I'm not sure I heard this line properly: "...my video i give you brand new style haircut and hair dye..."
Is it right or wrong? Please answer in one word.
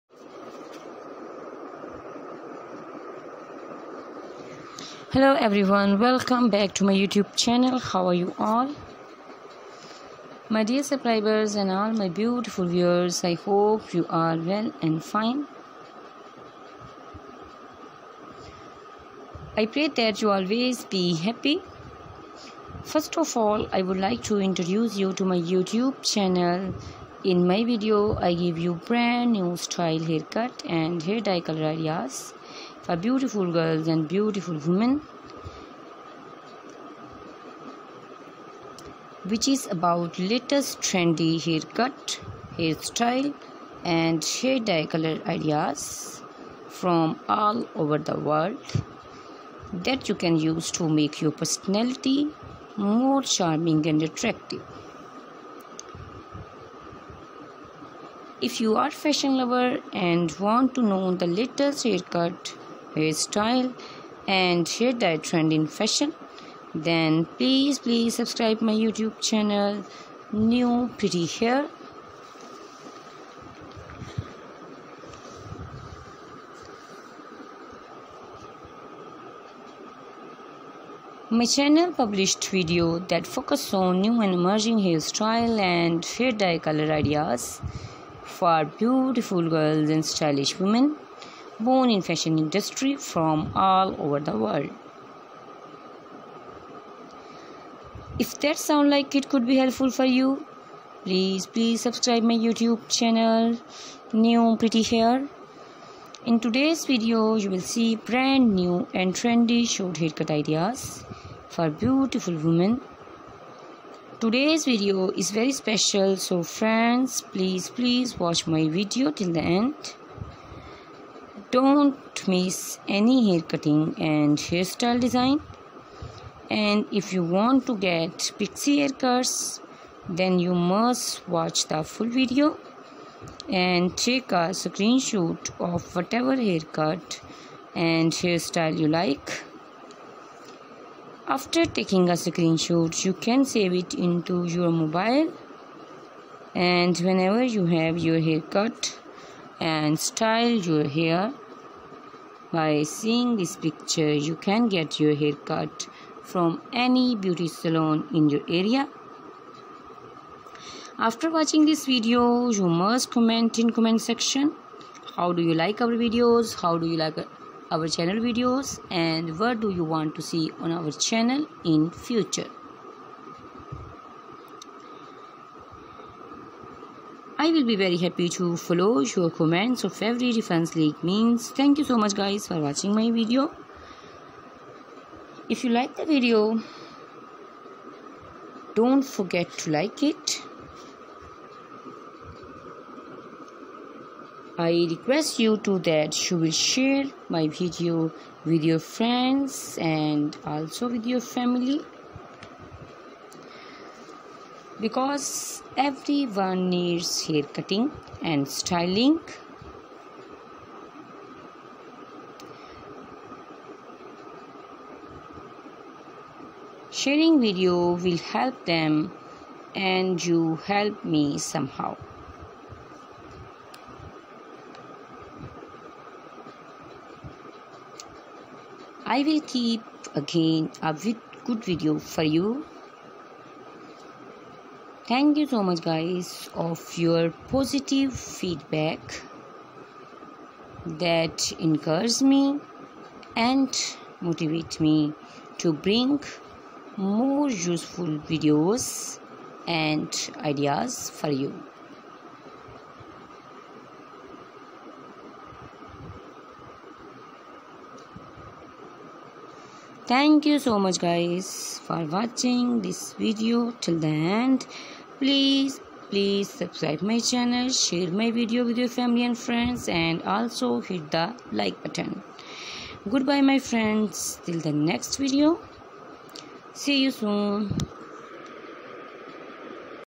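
right.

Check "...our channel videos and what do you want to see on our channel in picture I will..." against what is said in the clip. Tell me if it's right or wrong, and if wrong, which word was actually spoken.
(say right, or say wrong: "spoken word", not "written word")
wrong: "future", not "picture".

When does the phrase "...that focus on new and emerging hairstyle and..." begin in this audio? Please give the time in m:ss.
1:23.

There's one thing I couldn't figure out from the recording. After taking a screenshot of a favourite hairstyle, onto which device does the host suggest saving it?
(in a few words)
mobile.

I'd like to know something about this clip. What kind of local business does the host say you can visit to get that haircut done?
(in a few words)
beauty salon.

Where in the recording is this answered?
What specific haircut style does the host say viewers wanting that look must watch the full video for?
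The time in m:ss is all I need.
2:08.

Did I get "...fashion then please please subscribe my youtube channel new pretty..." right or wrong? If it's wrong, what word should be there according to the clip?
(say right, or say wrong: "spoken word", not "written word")
right.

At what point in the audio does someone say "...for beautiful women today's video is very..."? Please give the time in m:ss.
1:51.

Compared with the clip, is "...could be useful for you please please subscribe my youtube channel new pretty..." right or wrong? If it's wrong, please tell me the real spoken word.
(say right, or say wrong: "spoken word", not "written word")
wrong: "helpful", not "useful".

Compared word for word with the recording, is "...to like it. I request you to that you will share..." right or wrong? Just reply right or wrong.
right.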